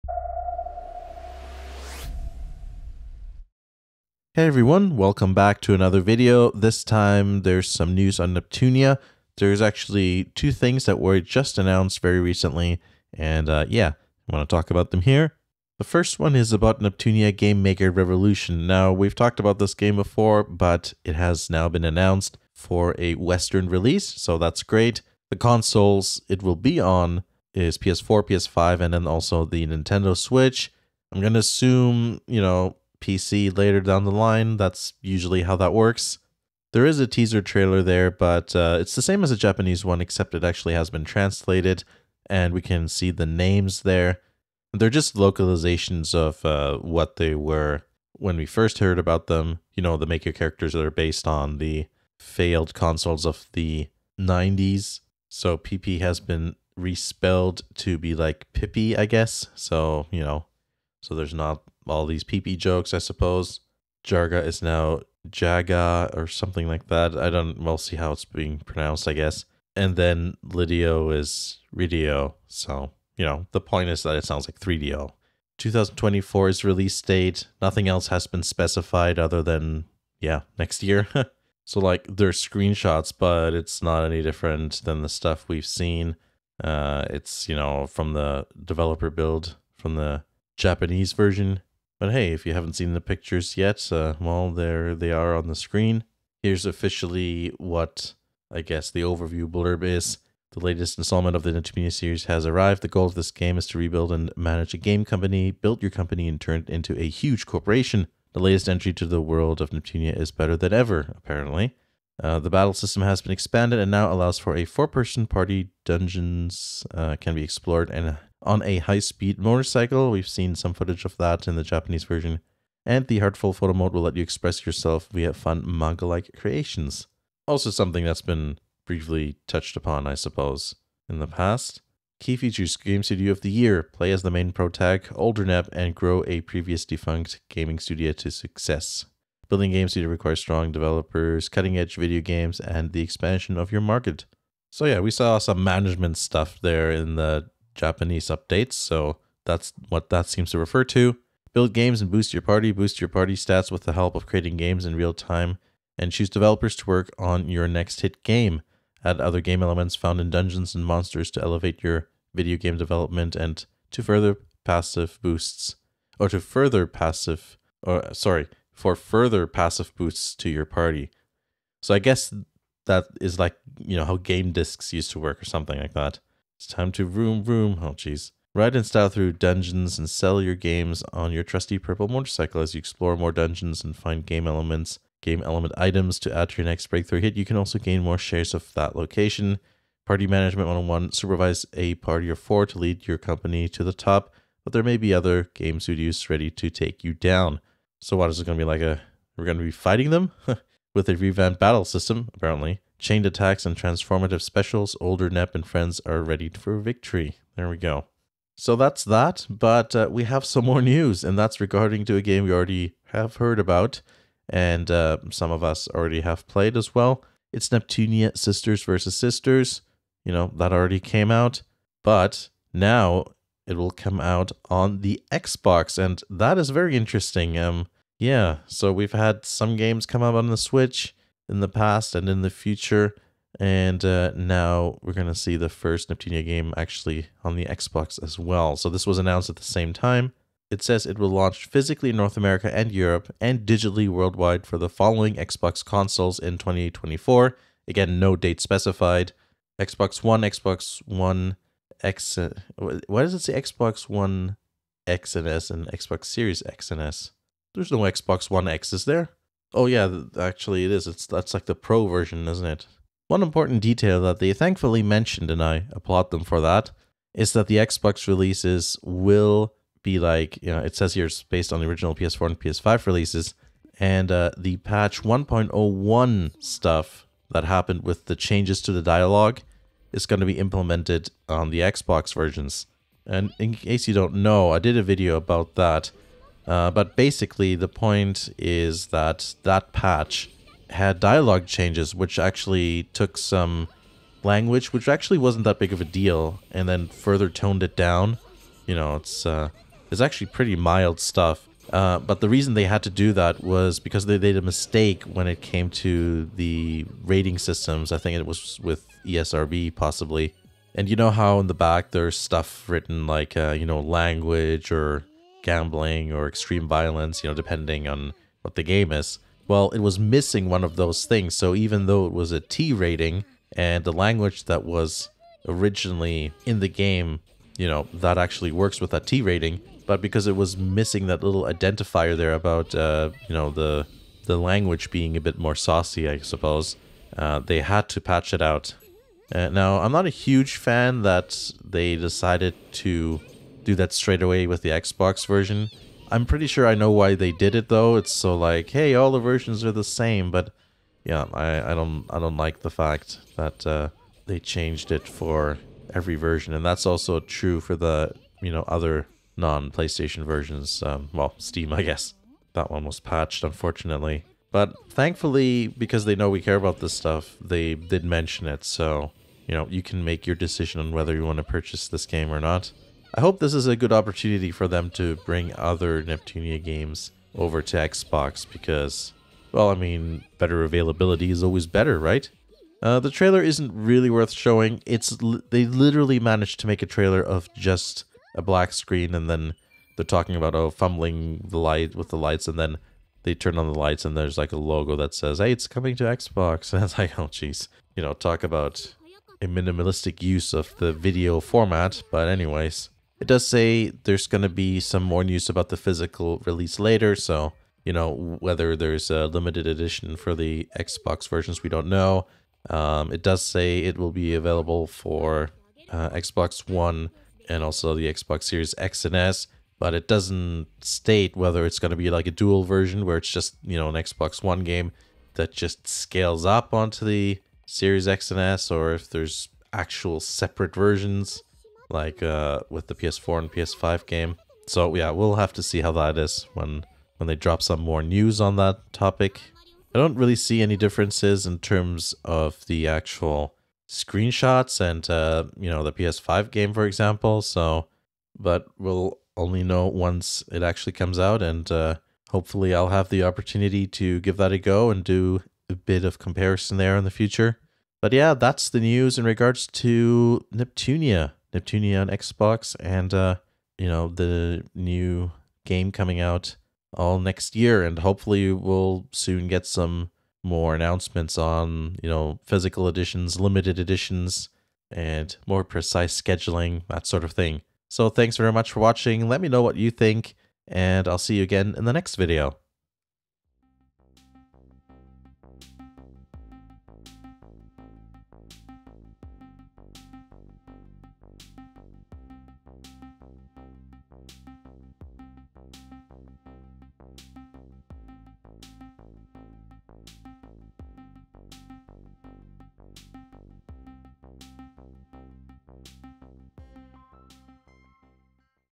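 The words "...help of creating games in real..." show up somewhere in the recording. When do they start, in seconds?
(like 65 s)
153 s.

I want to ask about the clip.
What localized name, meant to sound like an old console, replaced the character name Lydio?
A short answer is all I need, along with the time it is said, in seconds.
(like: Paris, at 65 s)
Ridio, at 71 s.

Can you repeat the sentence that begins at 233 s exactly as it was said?
And uh, now we're going to see the first Neptunia game actually on the Xbox as well.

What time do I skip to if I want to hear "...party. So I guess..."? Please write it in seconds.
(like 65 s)
170 s.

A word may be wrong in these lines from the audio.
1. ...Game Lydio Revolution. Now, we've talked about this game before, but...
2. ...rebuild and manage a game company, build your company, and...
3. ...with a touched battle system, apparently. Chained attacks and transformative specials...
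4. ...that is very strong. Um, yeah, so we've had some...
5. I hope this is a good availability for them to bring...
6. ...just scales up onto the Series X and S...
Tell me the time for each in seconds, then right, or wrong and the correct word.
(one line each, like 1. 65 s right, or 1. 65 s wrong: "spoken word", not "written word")
1. 17 s wrong: "Maker", not "Lydio"
2. 103 s right
3. 200 s wrong: "revamped", not "touched"
4. 226 s wrong: "interesting", not "strong"
5. 373 s wrong: "opportunity", not "availability"
6. 425 s right.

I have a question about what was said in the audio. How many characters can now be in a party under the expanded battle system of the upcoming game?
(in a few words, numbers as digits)
4.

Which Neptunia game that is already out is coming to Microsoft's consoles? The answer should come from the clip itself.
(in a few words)
Neptunia Sisters versus Sisters.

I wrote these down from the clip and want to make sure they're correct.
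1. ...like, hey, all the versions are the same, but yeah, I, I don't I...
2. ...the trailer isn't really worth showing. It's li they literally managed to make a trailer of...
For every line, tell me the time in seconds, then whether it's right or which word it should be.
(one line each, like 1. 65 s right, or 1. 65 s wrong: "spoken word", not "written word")
1. 348 s right
2. 383 s right.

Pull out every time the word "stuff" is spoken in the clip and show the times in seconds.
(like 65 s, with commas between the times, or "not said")
85 s, 146 s, 276 s, 301 s, 312 s, 367 s.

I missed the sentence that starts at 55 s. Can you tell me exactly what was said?
So PP has been respelled to be like Pippi, I guess.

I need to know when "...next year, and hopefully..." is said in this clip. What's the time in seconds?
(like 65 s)
467 s.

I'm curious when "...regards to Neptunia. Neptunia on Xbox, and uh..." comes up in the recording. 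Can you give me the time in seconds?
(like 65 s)
459 s.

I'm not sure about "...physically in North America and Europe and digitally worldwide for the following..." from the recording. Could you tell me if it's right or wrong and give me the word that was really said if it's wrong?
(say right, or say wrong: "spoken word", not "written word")
right.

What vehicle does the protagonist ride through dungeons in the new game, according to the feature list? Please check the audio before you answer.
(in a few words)
purple motorcycle.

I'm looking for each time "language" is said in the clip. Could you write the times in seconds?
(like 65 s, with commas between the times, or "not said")
294 s, 313 s, 324 s, 334 s.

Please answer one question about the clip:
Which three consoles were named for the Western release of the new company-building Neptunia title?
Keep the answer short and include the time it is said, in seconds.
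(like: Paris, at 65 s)
PS4, PS5, Nintendo Switch, at 27 s.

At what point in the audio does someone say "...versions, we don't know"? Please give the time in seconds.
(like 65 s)
411 s.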